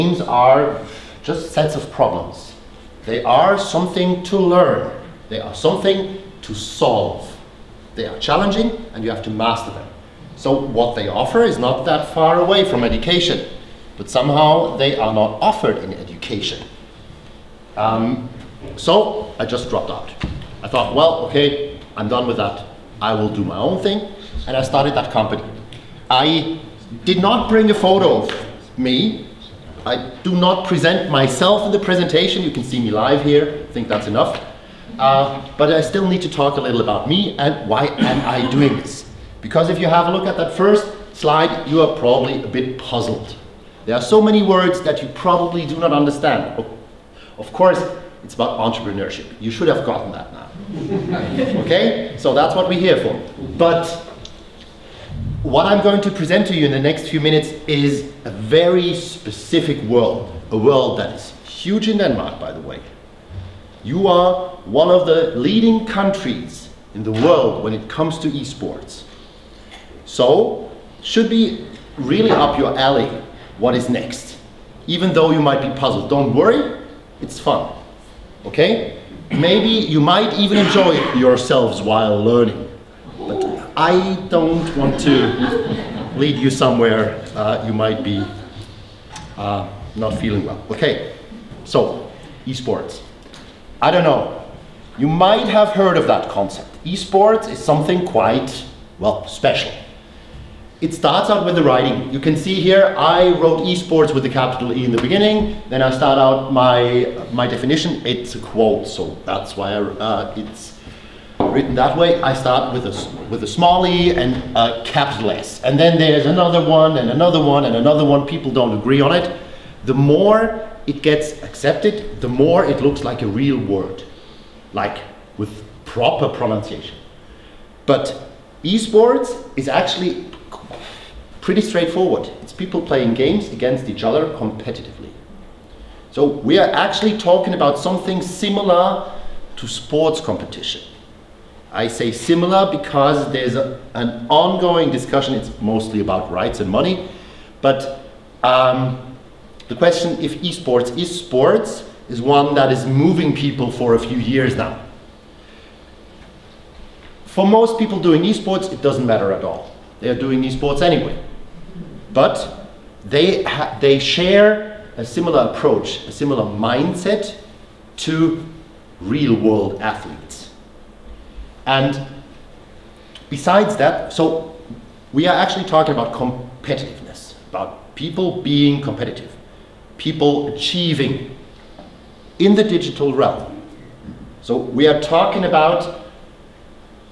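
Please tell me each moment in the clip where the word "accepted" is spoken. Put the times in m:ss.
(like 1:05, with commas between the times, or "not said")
2:01.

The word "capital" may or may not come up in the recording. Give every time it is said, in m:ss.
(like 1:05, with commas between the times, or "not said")
1:44, 1:54.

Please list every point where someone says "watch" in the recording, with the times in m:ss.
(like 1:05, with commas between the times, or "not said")
not said.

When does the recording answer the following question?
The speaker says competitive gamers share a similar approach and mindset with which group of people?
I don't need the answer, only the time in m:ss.
2:48.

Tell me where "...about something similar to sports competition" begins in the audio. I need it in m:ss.
2:17.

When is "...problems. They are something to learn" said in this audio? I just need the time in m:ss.
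0:01.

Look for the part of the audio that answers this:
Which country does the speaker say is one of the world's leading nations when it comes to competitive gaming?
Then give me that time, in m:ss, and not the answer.
1:01.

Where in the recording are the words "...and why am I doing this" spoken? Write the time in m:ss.
0:37.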